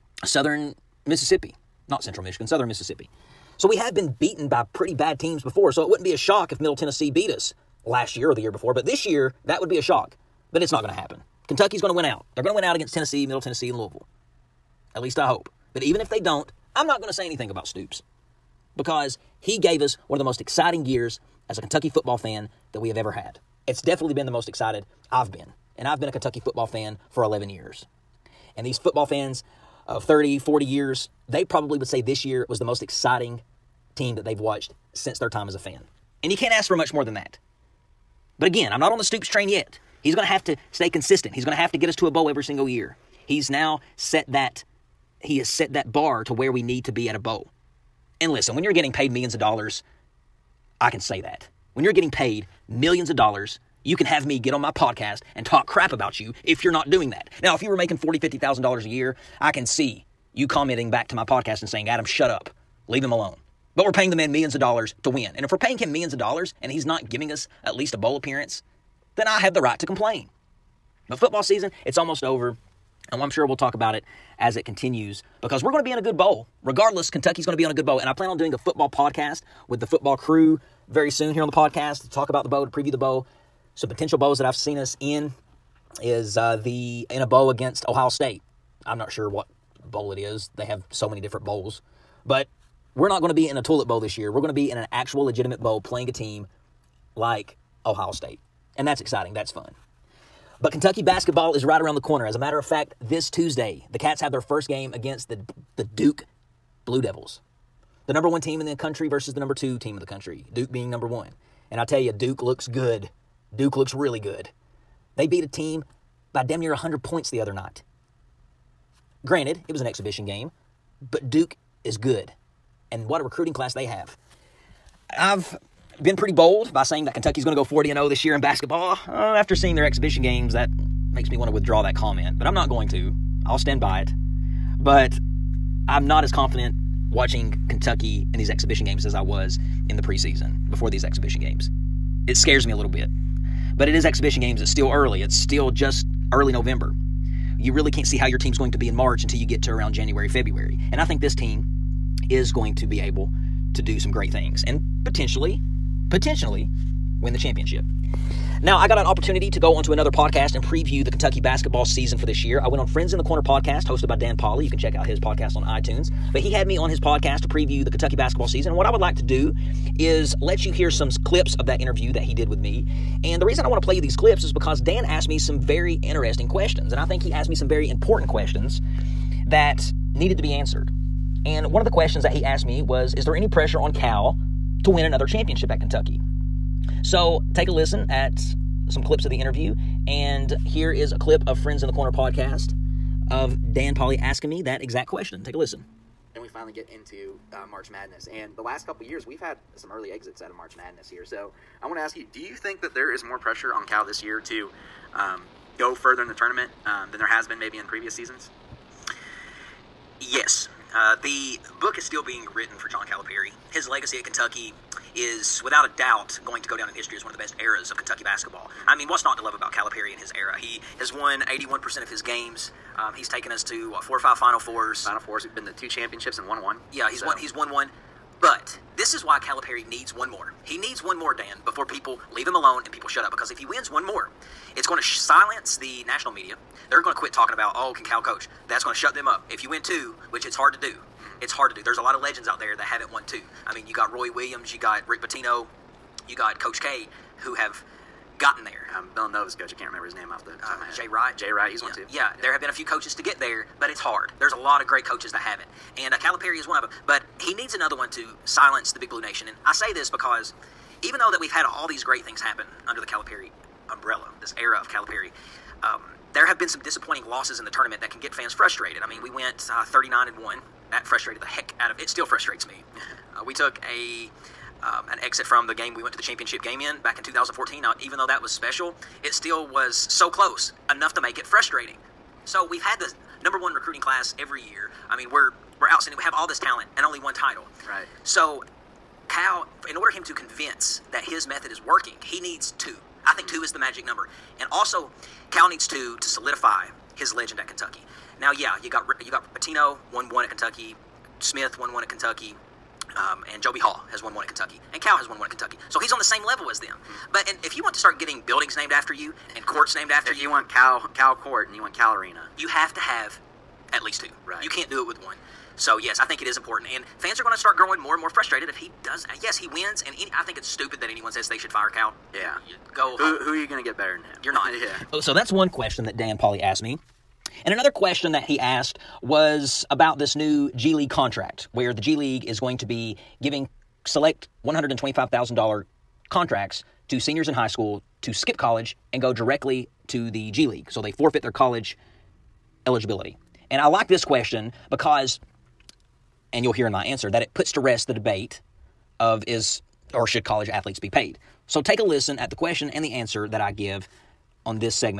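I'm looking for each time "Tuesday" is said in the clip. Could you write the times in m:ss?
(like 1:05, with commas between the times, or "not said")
1:43.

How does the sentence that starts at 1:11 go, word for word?
But football season, it's almost over.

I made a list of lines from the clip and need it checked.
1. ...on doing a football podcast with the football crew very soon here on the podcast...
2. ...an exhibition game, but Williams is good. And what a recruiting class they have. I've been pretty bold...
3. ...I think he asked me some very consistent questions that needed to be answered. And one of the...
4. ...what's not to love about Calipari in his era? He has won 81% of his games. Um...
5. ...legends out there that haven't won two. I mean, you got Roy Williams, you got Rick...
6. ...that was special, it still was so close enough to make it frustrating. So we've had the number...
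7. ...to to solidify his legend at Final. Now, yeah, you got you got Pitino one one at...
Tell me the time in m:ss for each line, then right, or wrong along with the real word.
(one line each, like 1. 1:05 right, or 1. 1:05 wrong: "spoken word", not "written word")
1. 1:18 right
2. 1:59 wrong: "Duke", not "Williams"
3. 2:56 wrong: "important", not "consistent"
4. 3:39 right
5. 4:02 right
6. 4:38 right
7. 4:55 wrong: "Kentucky", not "Final".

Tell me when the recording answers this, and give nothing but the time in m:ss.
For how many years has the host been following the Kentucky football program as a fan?
0:27.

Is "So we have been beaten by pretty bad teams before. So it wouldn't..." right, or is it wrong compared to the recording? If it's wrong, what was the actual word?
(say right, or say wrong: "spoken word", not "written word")
right.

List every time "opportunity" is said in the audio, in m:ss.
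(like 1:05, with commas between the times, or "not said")
2:39.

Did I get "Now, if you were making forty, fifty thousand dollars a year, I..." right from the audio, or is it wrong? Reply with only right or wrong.
right.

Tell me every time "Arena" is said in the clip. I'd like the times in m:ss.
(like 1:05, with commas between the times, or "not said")
5:12.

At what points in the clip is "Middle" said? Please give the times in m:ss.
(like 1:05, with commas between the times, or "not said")
0:06, 0:13.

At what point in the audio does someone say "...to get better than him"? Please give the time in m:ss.
5:23.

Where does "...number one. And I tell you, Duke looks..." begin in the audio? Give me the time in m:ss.
1:50.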